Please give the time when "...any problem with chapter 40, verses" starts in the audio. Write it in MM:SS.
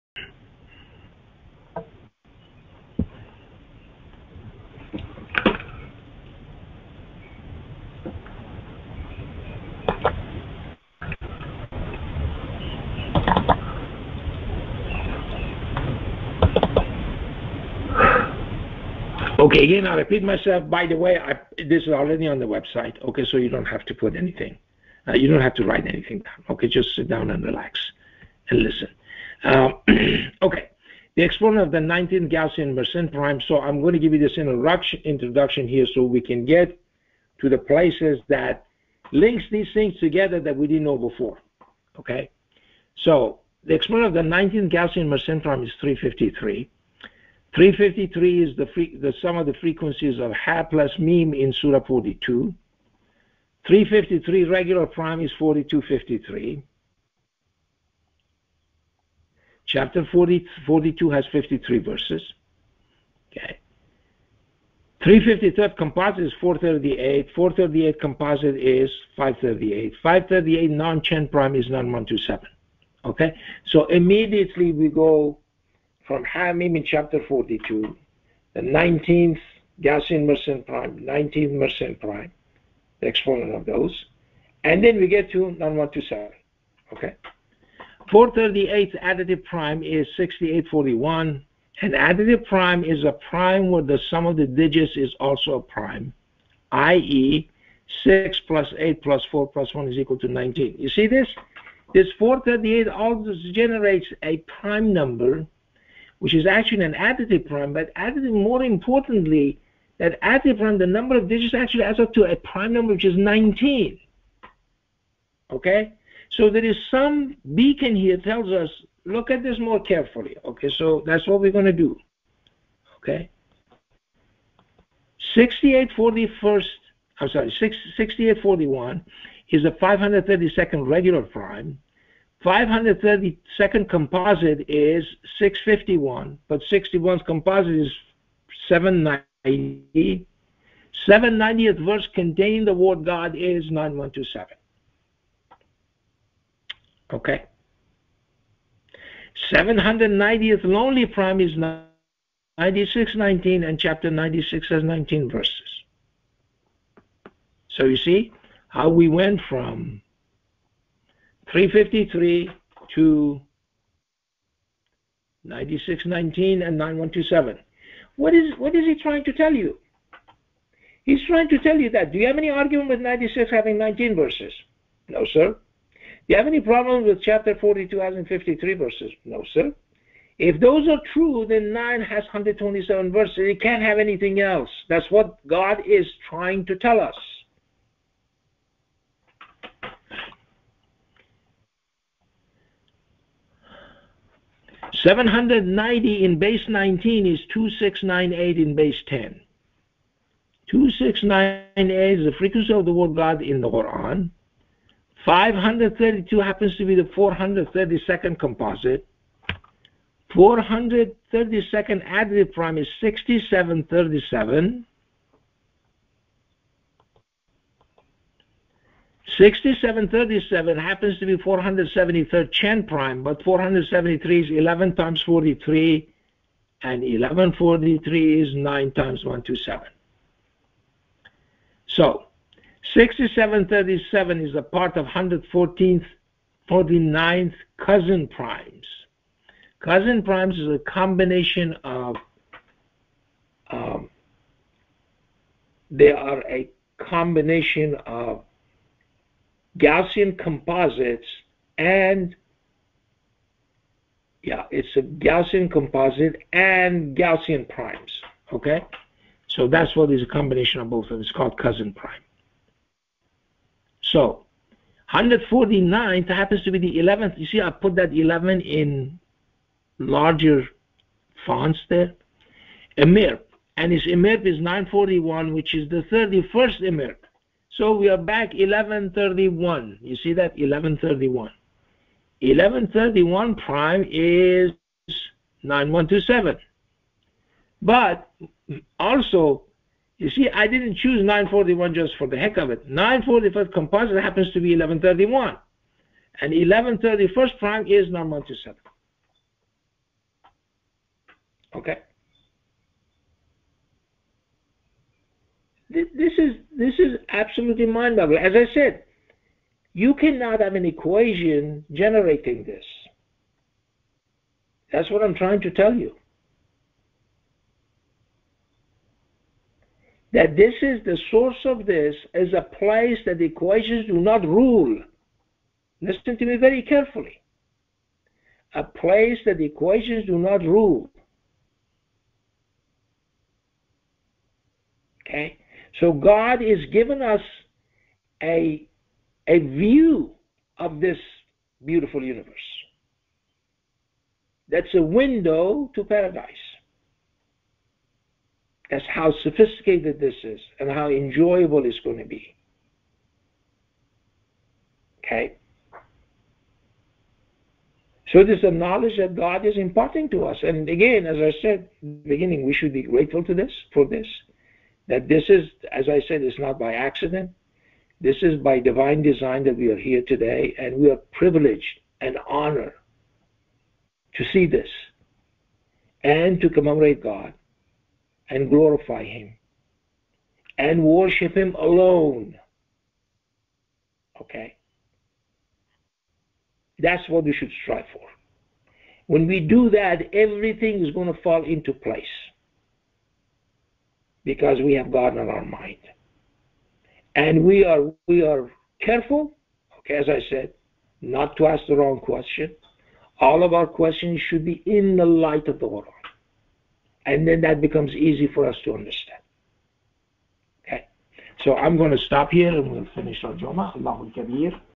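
02:56.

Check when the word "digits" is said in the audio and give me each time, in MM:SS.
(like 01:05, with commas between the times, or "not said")
01:34, 01:51.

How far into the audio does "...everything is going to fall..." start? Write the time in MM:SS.
06:30.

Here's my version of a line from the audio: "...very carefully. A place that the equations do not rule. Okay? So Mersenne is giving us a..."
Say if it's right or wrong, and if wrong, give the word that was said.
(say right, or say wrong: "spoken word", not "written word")
wrong: "God", not "Mersenne".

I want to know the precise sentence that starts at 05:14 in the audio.
That's what I'm trying to tell you.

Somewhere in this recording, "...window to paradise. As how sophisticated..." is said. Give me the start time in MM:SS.
05:45.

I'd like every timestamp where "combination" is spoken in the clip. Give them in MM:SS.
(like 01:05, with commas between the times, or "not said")
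04:00, 04:06, 04:20.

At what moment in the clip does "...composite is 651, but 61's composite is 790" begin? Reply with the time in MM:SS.
02:13.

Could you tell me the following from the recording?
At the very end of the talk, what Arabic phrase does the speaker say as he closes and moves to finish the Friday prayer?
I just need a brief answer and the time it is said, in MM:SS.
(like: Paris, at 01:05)
Allahu Akbar, at 06:53.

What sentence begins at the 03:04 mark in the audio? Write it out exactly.
That's what God is trying to tell us.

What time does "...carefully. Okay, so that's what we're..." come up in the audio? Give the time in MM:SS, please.
01:59.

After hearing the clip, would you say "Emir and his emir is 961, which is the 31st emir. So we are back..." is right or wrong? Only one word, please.
wrong.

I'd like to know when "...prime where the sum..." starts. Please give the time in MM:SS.
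01:33.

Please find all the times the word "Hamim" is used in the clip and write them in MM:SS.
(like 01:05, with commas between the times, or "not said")
01:16.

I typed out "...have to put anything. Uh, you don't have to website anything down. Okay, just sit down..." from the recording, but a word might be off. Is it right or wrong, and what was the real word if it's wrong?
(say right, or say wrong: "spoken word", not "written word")
wrong: "write", not "website".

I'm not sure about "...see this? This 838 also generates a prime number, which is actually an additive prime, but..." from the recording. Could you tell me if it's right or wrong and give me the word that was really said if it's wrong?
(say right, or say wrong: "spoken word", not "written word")
wrong: "438", not "838".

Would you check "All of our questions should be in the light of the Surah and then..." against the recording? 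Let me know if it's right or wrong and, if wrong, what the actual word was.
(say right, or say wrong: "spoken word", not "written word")
wrong: "Word", not "Surah".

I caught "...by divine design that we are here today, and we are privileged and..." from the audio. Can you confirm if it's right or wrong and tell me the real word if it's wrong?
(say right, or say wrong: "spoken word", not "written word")
right.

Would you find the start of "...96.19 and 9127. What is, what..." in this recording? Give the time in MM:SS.
02:45.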